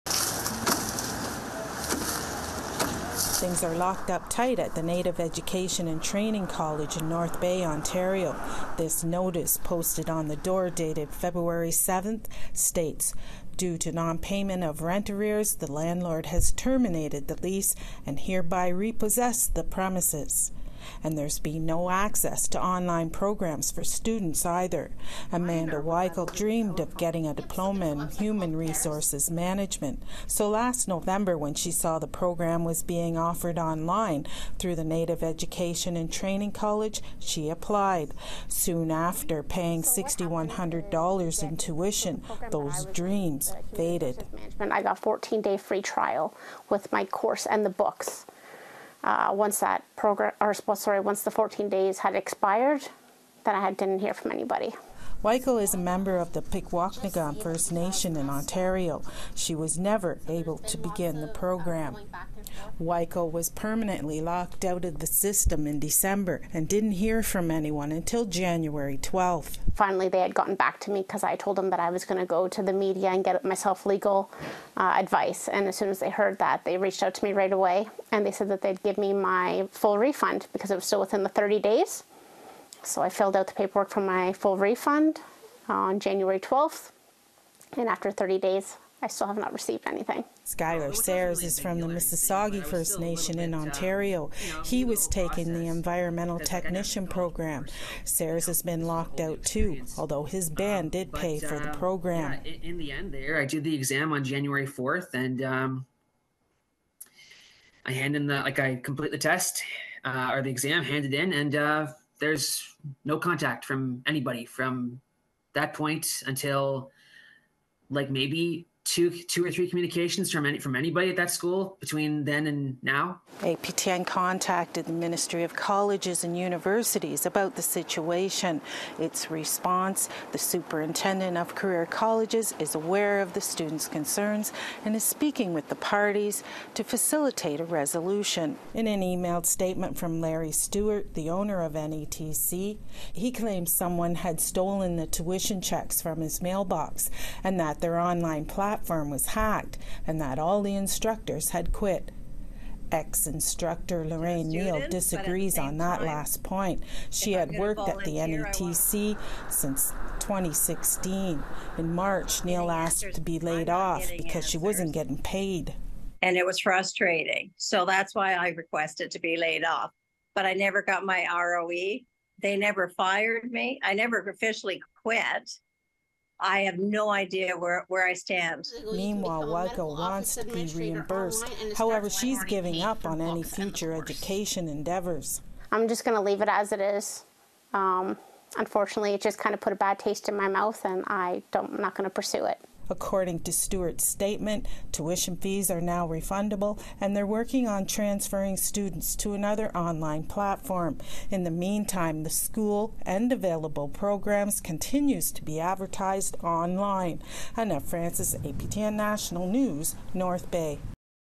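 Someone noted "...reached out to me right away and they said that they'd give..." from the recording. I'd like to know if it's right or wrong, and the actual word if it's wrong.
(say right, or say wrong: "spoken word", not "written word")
right.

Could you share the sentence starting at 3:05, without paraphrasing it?
I'm just going to leave it as it is.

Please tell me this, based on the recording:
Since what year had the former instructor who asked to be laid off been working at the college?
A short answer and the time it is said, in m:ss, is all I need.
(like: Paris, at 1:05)
2016, at 2:40.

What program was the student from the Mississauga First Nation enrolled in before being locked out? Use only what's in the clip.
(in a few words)
environmental technician.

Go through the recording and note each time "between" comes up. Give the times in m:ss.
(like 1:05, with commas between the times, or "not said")
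2:01.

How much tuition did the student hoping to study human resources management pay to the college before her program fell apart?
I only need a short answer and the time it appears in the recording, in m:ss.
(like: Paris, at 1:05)
$6,100, at 0:39.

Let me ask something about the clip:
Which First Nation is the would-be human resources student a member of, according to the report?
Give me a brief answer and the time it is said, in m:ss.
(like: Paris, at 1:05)
Pikwakanagan First Nation, at 0:56.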